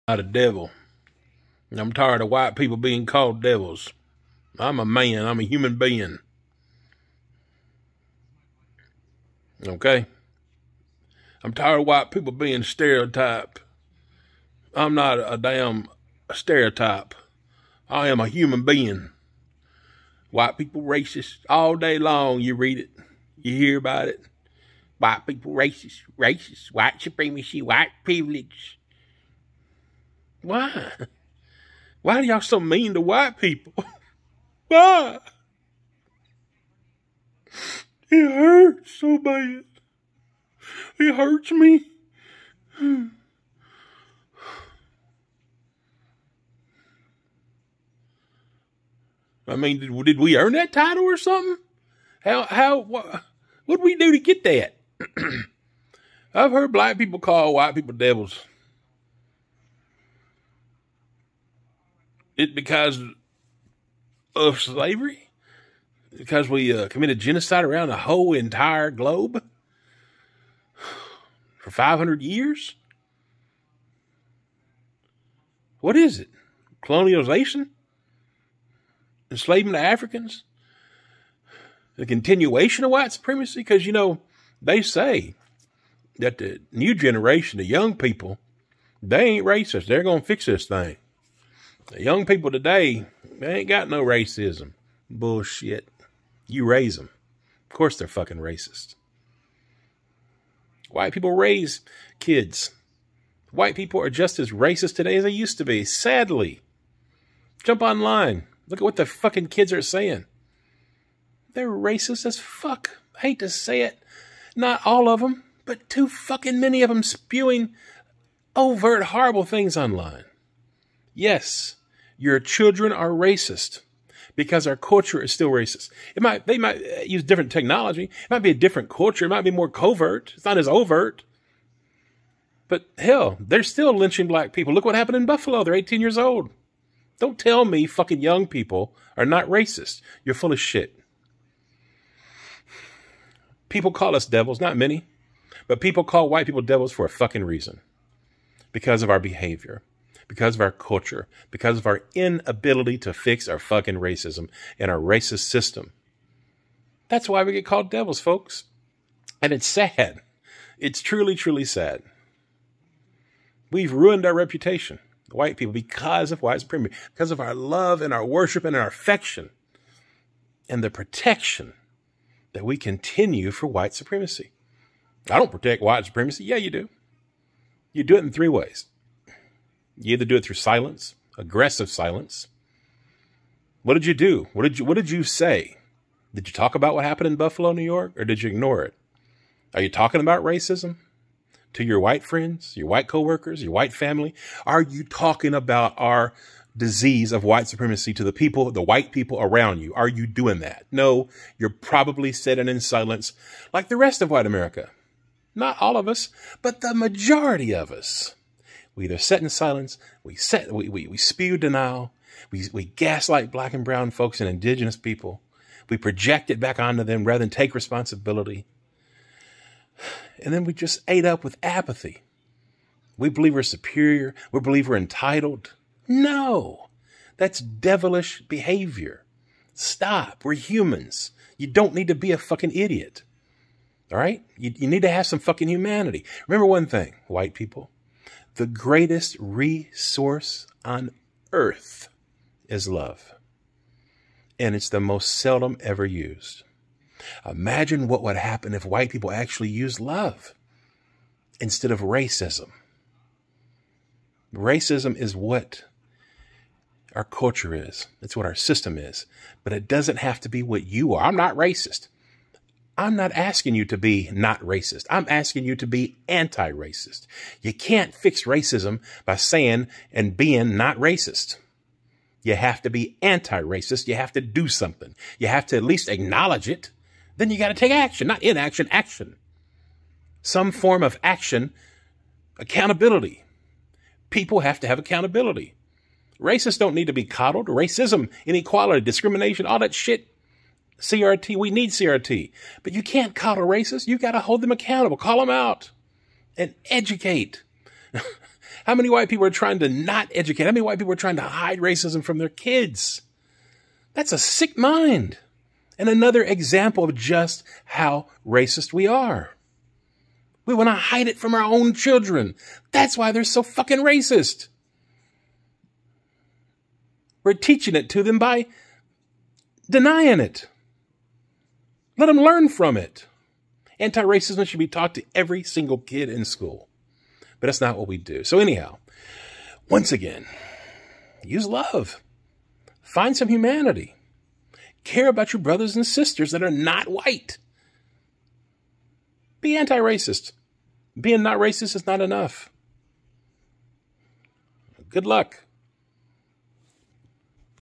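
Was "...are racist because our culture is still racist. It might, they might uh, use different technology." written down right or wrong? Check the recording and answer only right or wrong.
right.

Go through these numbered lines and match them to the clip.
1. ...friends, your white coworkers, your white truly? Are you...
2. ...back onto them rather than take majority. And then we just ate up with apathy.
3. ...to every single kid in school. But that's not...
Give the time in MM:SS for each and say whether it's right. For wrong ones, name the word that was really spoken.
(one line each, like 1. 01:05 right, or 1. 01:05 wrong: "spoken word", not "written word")
1. 03:12 wrong: "family", not "truly"
2. 03:36 wrong: "responsibility", not "majority"
3. 05:25 right.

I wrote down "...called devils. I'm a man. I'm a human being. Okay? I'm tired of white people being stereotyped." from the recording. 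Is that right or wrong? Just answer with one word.
right.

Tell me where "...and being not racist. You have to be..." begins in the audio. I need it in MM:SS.
04:30.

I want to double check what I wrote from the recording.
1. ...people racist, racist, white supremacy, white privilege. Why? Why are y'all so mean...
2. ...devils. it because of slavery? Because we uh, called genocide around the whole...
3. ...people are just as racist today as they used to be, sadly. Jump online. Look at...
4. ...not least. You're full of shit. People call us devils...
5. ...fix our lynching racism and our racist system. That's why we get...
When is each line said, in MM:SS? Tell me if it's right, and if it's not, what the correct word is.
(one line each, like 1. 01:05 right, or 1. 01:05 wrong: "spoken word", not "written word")
1. 00:25 right
2. 00:57 wrong: "committed", not "called"
3. 01:43 right
4. 02:19 wrong: "racist", not "least"
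5. 02:33 wrong: "fucking", not "lynching".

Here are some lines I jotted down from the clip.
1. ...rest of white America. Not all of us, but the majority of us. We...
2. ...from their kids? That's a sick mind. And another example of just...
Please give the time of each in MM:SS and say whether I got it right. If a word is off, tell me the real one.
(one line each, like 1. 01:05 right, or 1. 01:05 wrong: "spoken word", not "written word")
1. 03:23 right
2. 05:02 right.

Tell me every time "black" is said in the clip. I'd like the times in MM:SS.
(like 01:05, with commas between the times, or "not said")
00:56, 02:14, 03:33.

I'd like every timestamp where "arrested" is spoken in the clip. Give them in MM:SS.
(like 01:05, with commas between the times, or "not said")
not said.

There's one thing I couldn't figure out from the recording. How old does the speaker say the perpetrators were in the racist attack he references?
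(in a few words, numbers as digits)
18.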